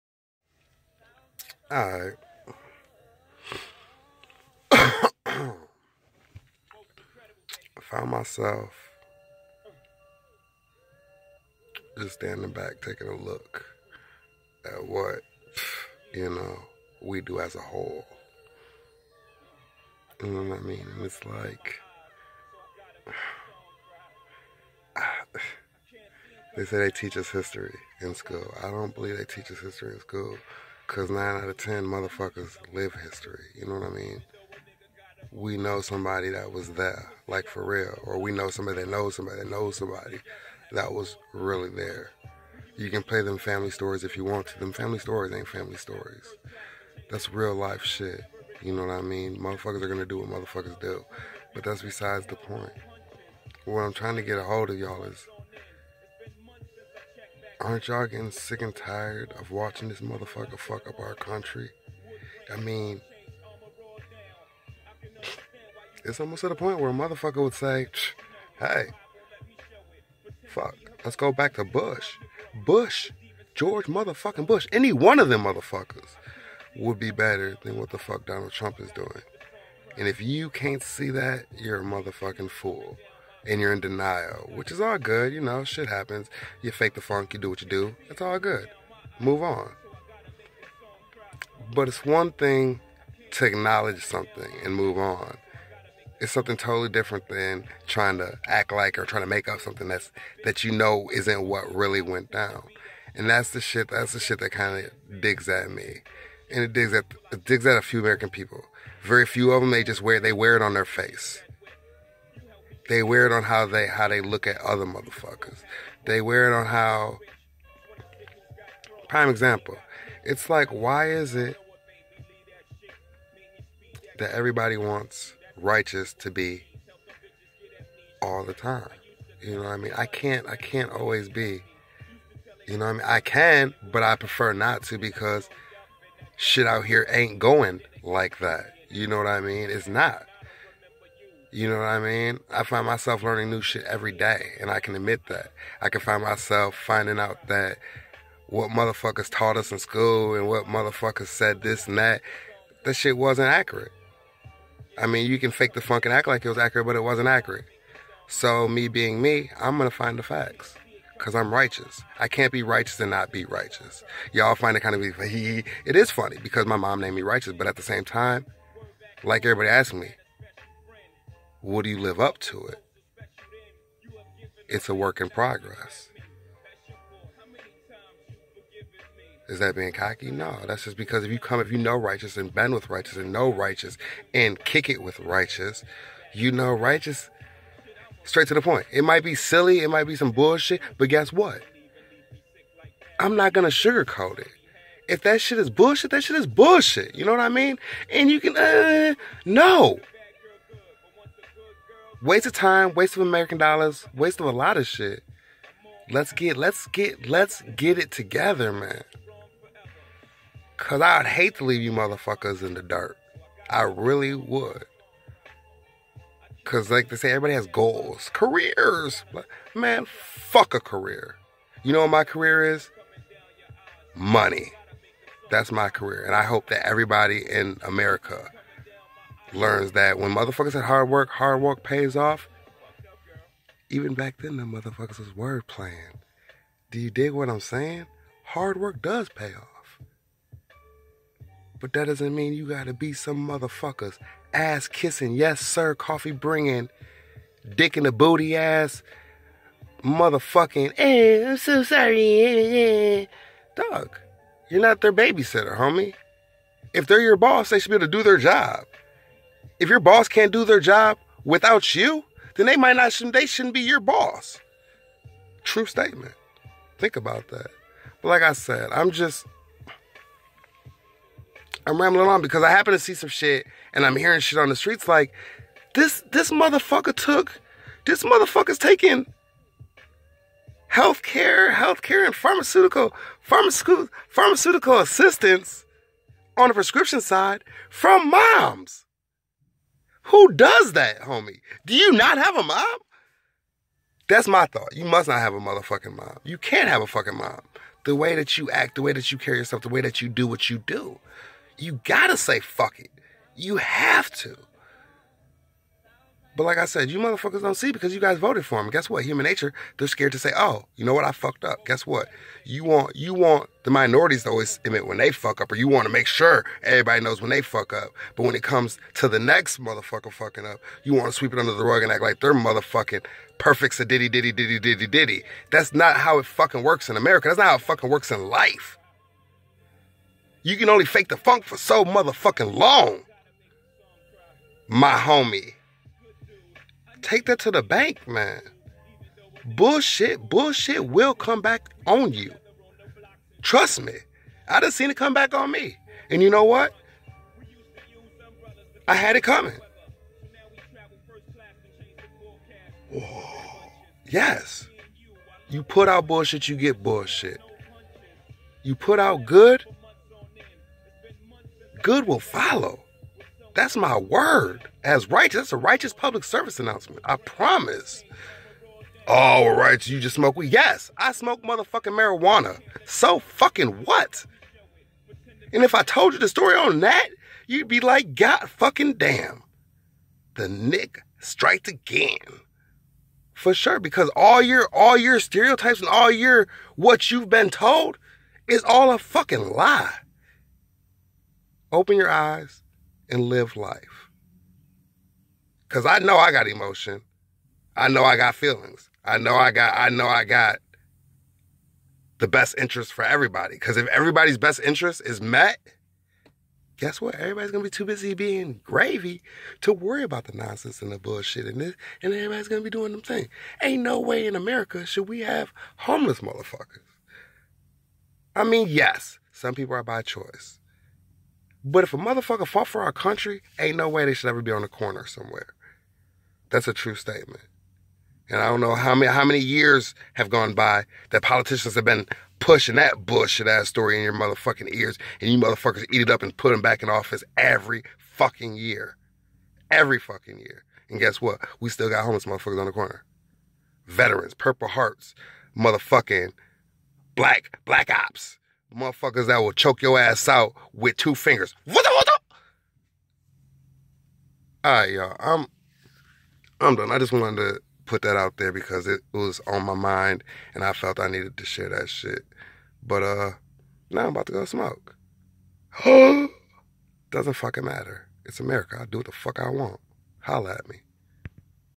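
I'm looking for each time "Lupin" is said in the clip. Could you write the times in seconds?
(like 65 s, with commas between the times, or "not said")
not said.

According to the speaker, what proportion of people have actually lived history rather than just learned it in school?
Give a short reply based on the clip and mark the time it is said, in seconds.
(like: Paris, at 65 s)
9 out of 10, at 31 s.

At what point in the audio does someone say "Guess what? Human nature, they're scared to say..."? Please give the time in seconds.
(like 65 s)
308 s.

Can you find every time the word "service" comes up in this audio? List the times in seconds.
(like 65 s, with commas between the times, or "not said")
366 s.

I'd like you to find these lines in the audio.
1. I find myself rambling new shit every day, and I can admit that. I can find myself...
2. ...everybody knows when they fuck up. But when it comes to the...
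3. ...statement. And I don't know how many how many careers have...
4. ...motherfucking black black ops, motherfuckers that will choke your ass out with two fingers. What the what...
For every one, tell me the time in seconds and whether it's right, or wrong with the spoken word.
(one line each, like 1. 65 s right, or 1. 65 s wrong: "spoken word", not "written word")
1. 142 s wrong: "learning", not "rambling"
2. 316 s right
3. 427 s wrong: "years", not "careers"
4. 445 s right.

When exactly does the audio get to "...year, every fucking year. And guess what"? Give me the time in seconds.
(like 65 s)
438 s.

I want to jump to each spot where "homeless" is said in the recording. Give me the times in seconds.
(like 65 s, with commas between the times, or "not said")
415 s, 442 s.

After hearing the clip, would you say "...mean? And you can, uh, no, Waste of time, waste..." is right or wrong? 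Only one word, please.
right.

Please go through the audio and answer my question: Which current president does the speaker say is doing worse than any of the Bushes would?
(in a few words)
Donald Trump.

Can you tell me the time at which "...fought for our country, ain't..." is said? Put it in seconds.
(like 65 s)
422 s.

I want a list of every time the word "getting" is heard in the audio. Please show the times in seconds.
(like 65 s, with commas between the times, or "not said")
58 s.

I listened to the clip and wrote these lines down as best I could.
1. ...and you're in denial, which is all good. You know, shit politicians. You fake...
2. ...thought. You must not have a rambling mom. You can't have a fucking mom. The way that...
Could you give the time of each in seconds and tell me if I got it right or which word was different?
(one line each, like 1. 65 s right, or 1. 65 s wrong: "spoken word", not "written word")
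1. 83 s wrong: "happens", not "politicians"
2. 294 s wrong: "motherfucking", not "rambling".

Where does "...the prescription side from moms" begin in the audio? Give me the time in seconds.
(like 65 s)
286 s.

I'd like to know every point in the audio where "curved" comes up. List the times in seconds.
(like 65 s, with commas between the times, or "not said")
not said.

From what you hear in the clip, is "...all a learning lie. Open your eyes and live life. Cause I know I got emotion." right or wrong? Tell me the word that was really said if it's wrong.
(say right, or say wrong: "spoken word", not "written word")
wrong: "fucking", not "learning".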